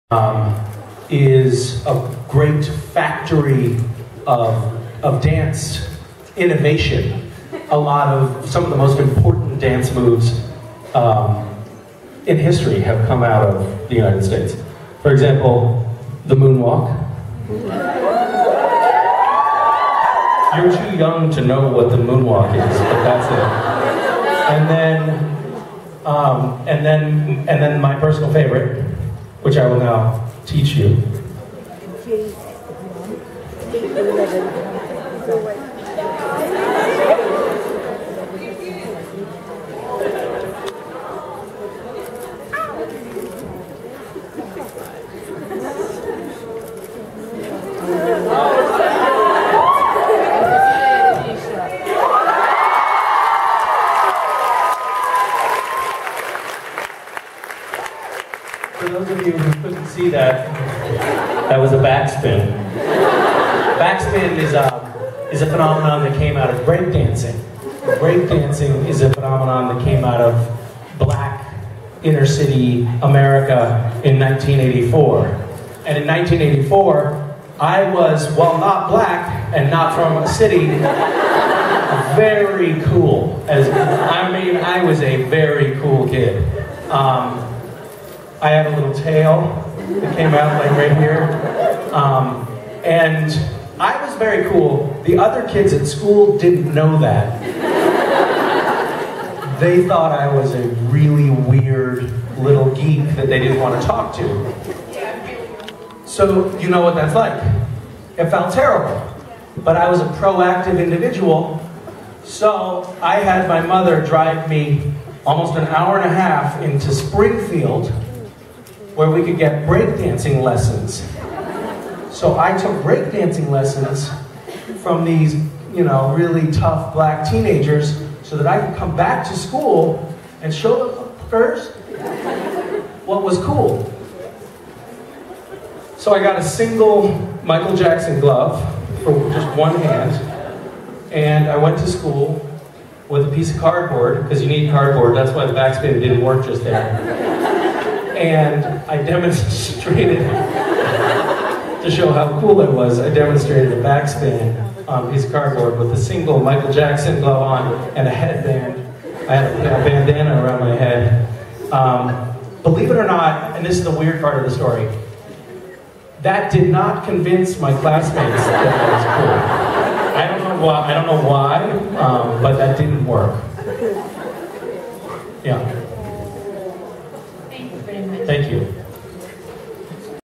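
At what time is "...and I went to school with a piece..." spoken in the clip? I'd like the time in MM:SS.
02:21.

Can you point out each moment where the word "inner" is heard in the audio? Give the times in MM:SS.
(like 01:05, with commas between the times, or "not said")
01:12.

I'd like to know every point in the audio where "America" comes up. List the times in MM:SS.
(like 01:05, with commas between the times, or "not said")
01:13.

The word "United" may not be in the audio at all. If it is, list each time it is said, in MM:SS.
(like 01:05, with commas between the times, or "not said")
00:13.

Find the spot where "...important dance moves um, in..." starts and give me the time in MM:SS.
00:08.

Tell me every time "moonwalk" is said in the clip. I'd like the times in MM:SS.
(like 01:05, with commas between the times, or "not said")
00:16, 00:21.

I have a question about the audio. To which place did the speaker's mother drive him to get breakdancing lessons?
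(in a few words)
Springfield.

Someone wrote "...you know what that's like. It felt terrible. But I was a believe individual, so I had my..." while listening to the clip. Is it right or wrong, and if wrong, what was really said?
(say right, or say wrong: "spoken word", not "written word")
wrong: "proactive", not "believe".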